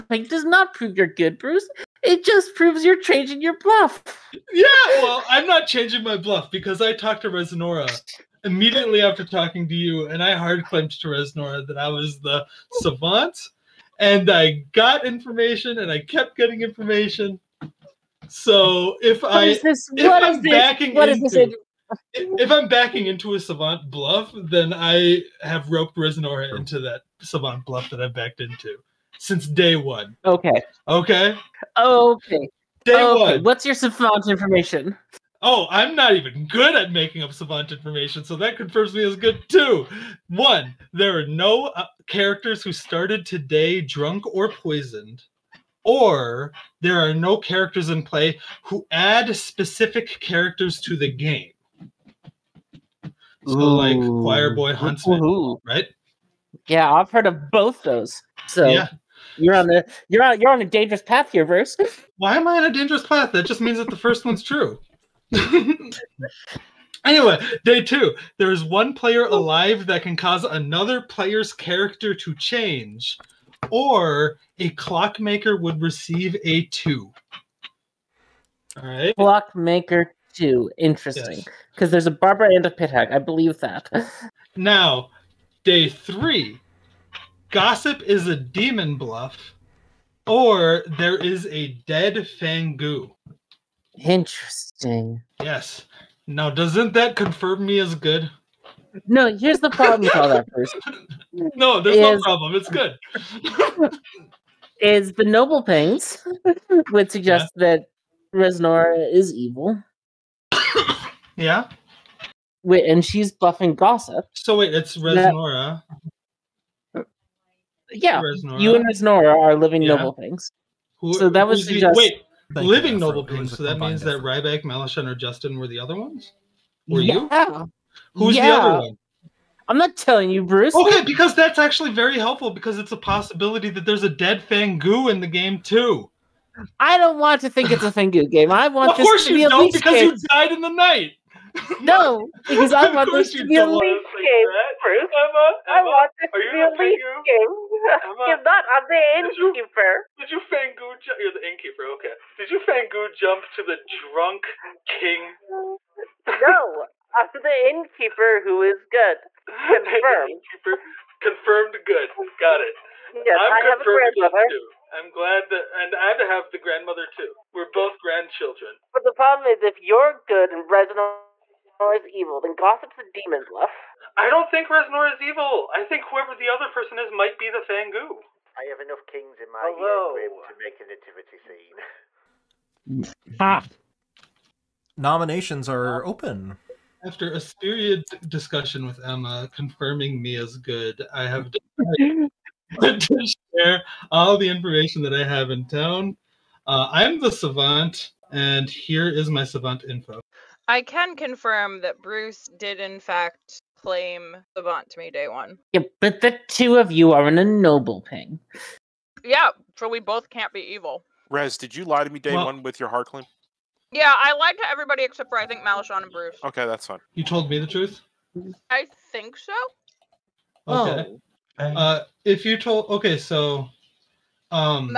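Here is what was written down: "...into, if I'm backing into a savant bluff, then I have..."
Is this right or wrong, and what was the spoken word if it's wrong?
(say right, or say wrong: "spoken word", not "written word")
right.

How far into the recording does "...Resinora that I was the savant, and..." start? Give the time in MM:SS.
00:11.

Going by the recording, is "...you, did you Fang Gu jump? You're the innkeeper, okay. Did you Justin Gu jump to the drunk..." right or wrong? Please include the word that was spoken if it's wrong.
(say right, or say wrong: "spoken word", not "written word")
wrong: "Fang", not "Justin".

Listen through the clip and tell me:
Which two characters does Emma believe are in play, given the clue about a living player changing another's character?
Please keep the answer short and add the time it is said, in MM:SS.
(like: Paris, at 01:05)
a barber and a pit hag, at 01:21.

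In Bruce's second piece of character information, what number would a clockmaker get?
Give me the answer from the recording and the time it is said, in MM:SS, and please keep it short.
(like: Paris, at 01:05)
2, at 01:14.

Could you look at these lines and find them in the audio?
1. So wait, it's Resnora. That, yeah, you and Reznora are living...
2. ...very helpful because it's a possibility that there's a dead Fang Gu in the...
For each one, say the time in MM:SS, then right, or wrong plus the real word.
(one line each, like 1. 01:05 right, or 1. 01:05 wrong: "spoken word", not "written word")
1. 01:54 right
2. 02:11 right.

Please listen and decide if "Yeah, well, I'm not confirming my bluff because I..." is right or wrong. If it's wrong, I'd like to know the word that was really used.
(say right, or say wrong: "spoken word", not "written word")
wrong: "changing", not "confirming".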